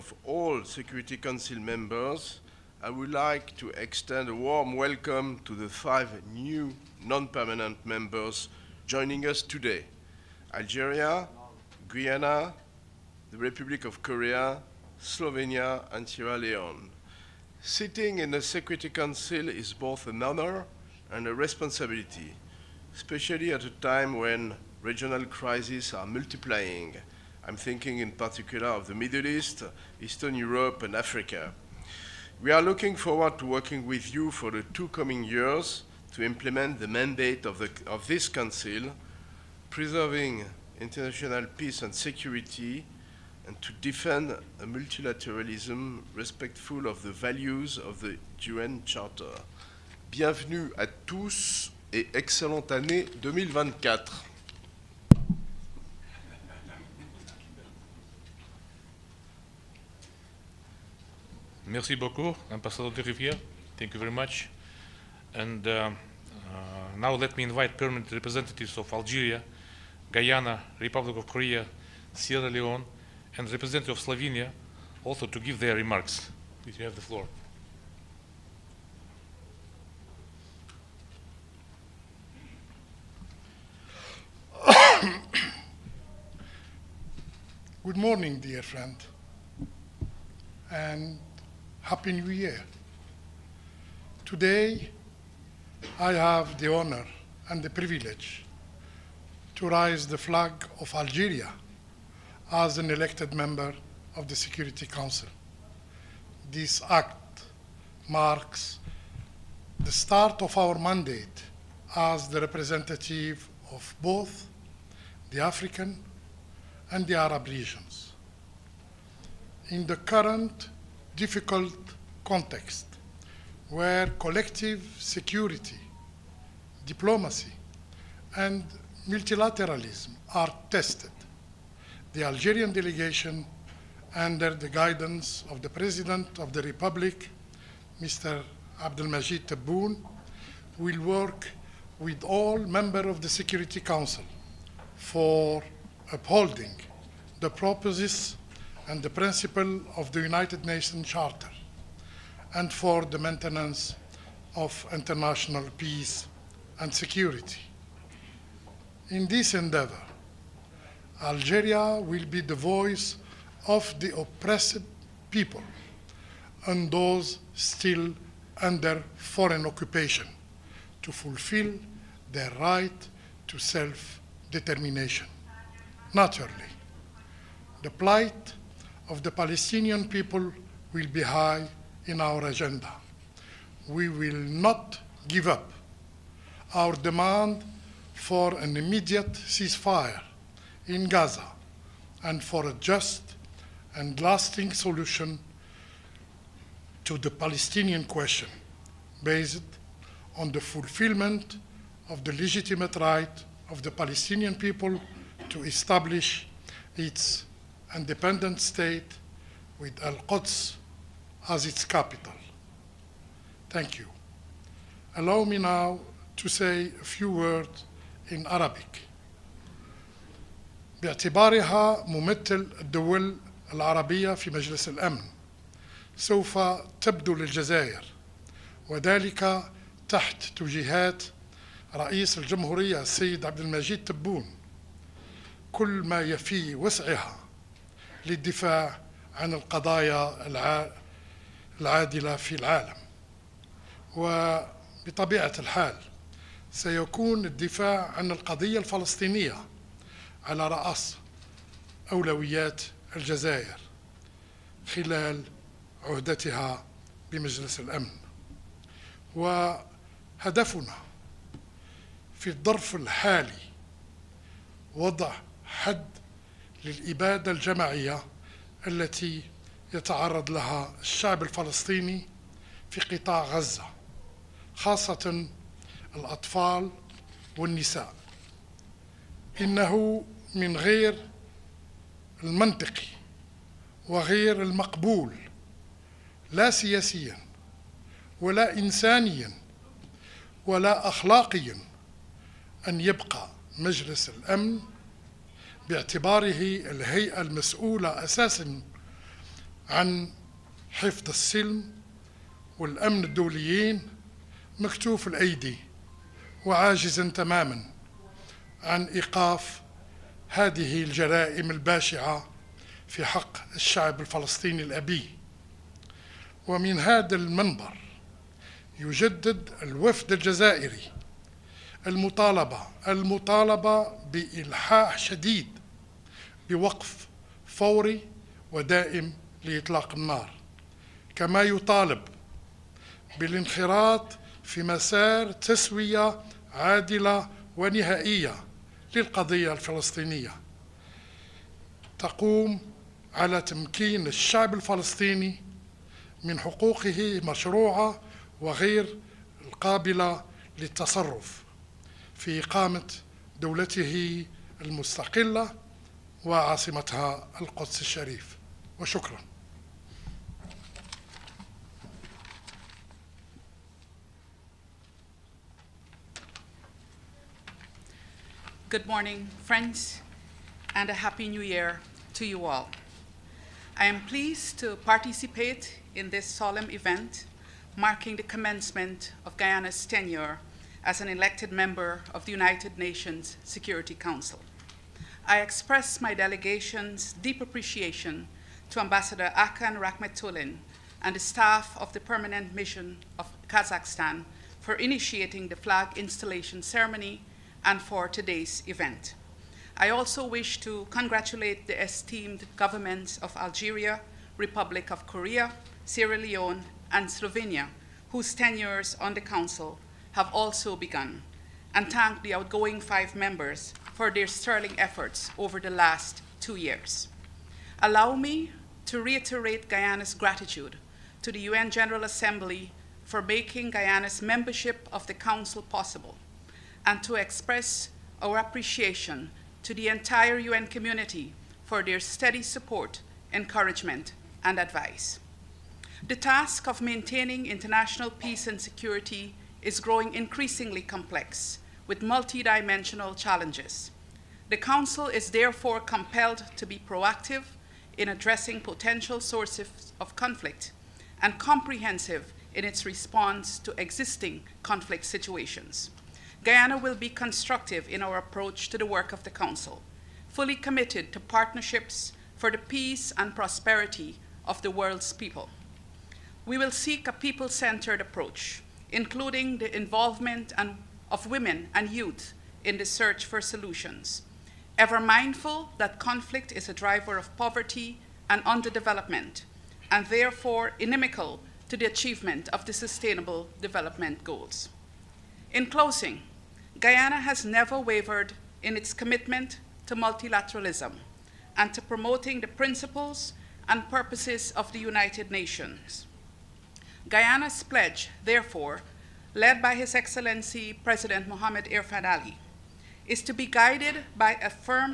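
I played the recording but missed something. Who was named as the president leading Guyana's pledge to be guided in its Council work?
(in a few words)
Mohamed Irfan Ali.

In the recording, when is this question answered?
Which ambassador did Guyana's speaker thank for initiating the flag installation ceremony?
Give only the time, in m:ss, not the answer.
6:29.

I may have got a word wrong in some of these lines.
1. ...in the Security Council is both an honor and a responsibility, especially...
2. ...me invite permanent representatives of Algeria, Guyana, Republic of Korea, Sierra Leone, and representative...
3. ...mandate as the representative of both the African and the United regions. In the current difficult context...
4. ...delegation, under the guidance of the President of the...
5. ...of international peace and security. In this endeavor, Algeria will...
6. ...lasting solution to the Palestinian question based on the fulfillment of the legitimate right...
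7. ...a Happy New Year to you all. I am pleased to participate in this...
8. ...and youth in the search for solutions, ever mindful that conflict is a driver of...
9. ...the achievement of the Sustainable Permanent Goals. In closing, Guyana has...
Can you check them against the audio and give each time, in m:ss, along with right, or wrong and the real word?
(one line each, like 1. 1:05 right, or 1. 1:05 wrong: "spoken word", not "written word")
1. 0:18 right
2. 1:07 right
3. 1:50 wrong: "Arab", not "United"
4. 2:12 right
5. 2:34 right
6. 3:14 right
7. 6:11 right
8. 7:51 right
9. 8:01 wrong: "Development", not "Permanent".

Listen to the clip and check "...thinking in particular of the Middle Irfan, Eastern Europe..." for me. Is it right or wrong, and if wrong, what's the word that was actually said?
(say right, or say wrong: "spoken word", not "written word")
wrong: "East", not "Irfan".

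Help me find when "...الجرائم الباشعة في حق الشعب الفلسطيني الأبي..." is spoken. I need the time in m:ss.
5:11.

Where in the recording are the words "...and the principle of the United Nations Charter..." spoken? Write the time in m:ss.
2:28.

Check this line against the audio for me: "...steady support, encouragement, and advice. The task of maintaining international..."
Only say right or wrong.
right.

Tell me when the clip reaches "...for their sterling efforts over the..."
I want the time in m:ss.
6:54.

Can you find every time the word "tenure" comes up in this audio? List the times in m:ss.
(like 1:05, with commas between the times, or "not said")
6:20, 6:48.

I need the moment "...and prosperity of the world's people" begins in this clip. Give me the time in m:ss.
7:43.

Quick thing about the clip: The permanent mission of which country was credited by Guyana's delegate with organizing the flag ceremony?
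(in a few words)
Kazakhstan.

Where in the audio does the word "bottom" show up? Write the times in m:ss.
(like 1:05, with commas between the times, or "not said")
not said.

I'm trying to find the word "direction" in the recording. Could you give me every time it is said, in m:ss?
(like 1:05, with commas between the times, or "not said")
not said.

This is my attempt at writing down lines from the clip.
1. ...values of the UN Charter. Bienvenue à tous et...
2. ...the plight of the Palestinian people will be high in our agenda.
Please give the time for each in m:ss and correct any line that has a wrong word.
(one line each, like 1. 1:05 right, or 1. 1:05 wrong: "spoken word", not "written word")
1. 0:47 right
2. 2:57 right.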